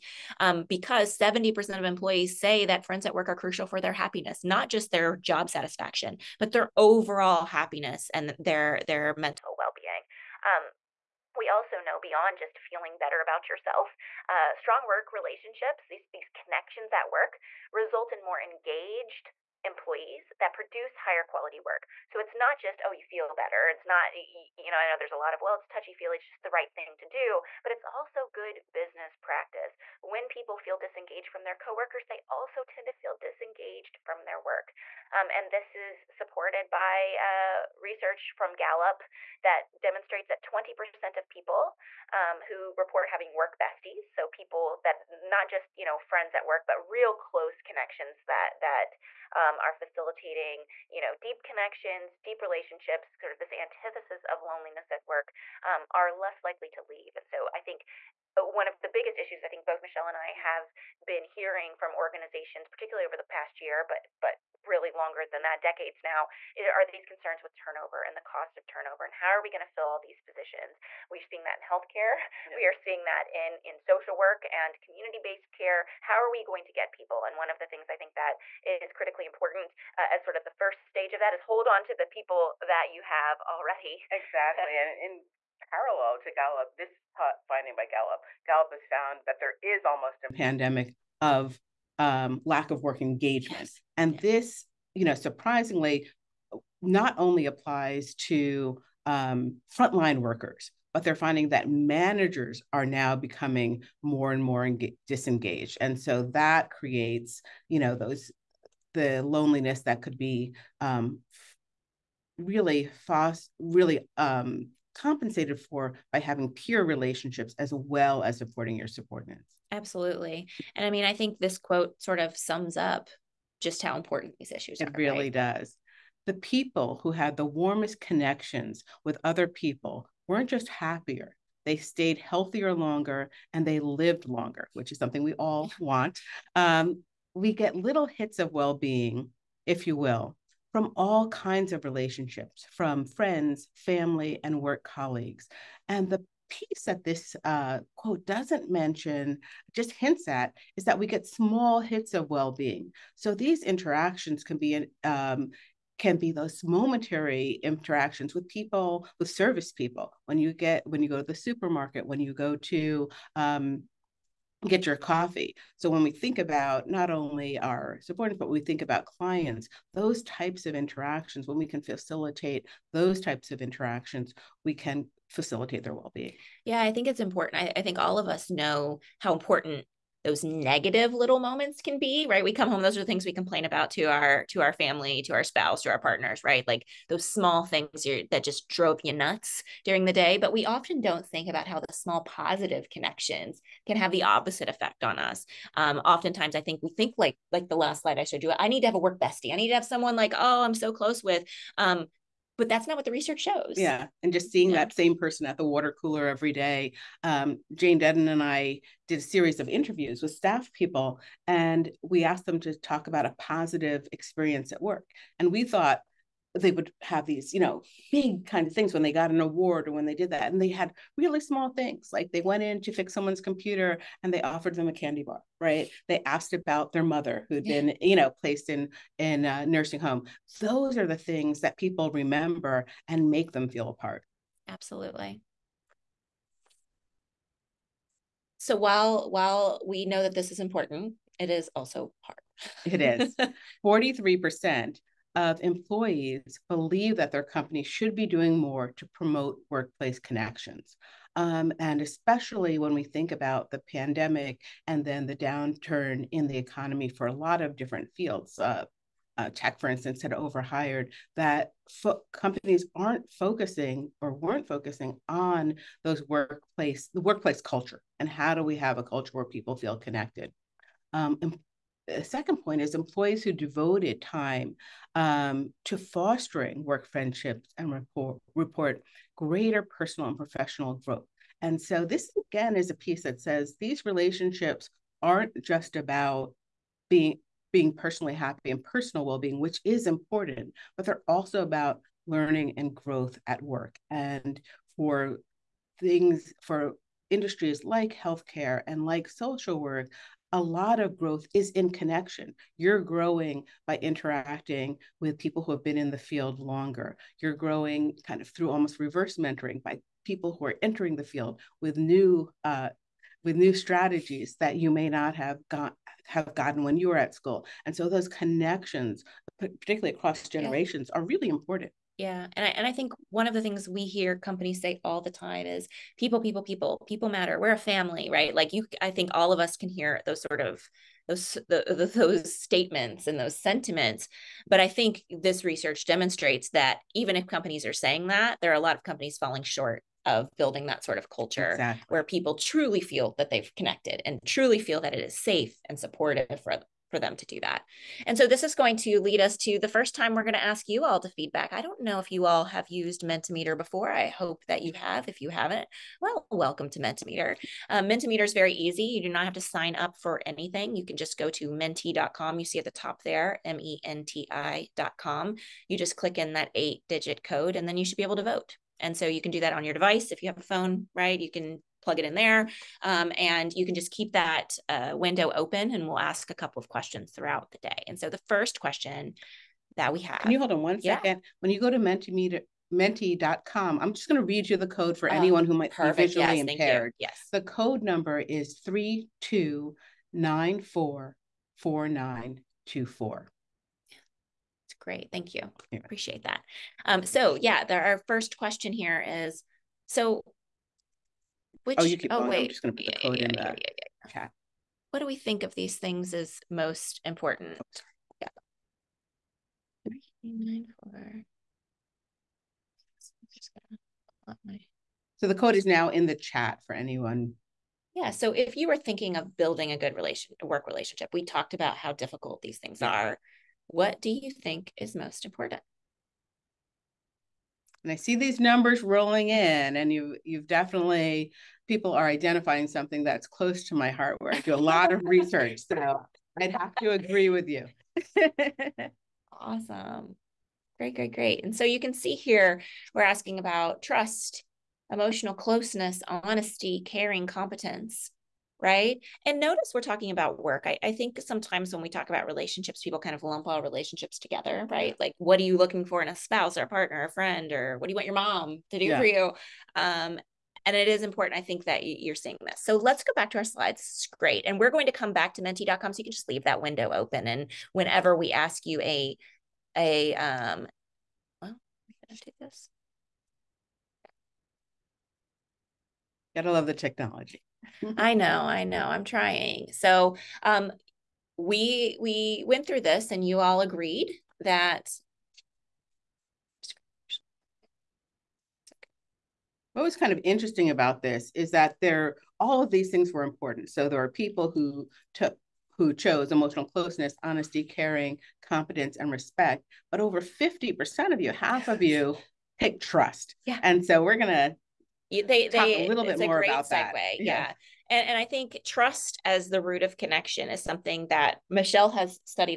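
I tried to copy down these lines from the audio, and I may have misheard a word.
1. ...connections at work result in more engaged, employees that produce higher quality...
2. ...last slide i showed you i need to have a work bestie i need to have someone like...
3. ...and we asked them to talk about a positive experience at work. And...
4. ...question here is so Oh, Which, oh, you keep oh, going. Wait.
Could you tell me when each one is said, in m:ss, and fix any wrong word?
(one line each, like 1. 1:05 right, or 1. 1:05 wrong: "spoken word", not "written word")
1. 0:16 right
2. 3:17 right
3. 3:31 right
4. 6:38 right.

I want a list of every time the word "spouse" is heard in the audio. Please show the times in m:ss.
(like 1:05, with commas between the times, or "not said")
3:05, 7:36.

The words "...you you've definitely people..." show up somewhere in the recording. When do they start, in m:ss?
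7:10.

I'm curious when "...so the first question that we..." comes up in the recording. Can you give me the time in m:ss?
6:18.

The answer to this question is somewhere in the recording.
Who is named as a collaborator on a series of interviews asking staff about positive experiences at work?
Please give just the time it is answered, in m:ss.
3:27.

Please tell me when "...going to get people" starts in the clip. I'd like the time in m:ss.
1:16.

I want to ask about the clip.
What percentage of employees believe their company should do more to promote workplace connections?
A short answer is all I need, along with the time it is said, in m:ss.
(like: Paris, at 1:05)
43%, at 4:03.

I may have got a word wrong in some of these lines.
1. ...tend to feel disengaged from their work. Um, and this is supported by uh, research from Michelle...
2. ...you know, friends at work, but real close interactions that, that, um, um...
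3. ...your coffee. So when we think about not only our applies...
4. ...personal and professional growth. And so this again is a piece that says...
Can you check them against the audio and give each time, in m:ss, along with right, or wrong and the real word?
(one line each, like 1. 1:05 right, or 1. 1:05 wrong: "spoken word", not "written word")
1. 0:32 wrong: "Gallup", not "Michelle"
2. 0:45 wrong: "connections", not "interactions"
3. 2:44 wrong: "subordinates", not "applies"
4. 4:39 right.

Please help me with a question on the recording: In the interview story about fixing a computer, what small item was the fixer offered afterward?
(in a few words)
a candy bar.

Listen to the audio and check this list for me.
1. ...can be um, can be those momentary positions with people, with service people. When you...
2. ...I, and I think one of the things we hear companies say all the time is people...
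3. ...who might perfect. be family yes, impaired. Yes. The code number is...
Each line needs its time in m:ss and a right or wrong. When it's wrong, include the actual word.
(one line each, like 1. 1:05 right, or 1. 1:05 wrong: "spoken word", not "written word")
1. 2:34 wrong: "interactions", not "positions"
2. 5:22 right
3. 6:25 wrong: "visually", not "family".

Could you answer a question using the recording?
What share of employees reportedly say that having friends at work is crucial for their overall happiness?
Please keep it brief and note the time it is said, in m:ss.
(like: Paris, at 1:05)
70%, at 0:01.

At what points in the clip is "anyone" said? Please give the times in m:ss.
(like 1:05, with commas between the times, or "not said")
6:25, 6:56.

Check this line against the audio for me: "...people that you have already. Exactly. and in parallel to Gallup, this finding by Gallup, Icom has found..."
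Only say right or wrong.
wrong.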